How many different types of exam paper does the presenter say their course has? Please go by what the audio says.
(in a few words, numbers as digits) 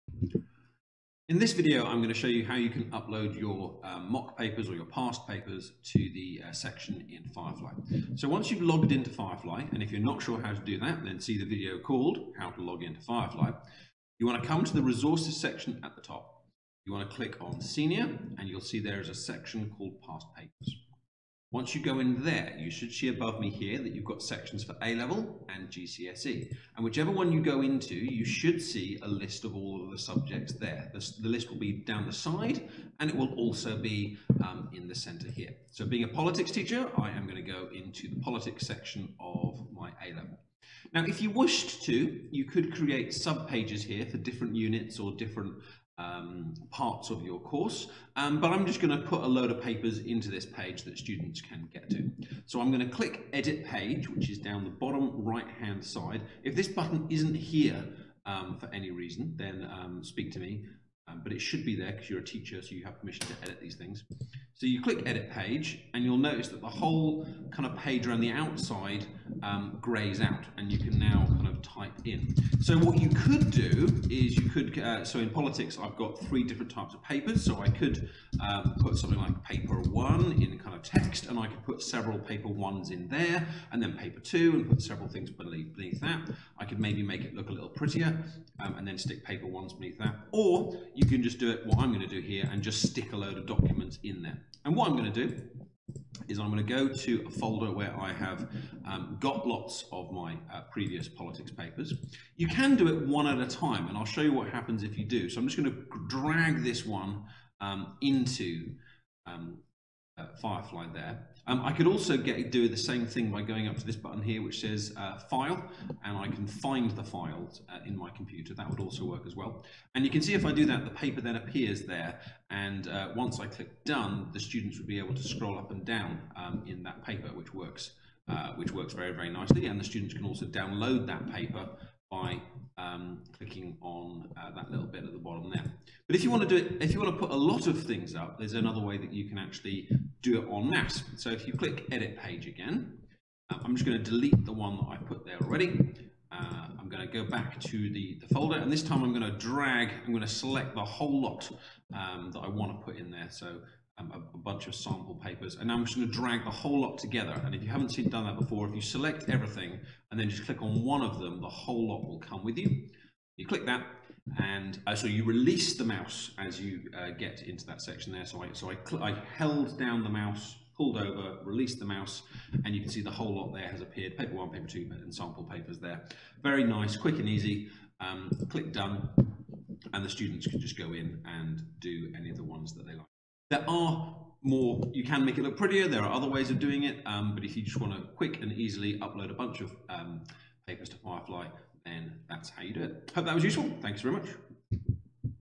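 3.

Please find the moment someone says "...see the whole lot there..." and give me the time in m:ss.
2:52.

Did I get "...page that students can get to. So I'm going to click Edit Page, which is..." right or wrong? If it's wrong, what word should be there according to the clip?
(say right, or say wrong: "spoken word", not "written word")
right.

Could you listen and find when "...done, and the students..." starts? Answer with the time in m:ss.
2:58.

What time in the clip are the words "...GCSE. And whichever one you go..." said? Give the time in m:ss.
0:25.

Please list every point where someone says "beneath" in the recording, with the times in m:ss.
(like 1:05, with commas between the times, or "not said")
1:25, 1:29.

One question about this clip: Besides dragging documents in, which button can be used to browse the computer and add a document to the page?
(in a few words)
File.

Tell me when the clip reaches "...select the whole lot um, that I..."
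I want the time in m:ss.
2:30.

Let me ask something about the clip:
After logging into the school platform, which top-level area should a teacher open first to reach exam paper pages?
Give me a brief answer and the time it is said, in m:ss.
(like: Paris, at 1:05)
Resources, at 0:14.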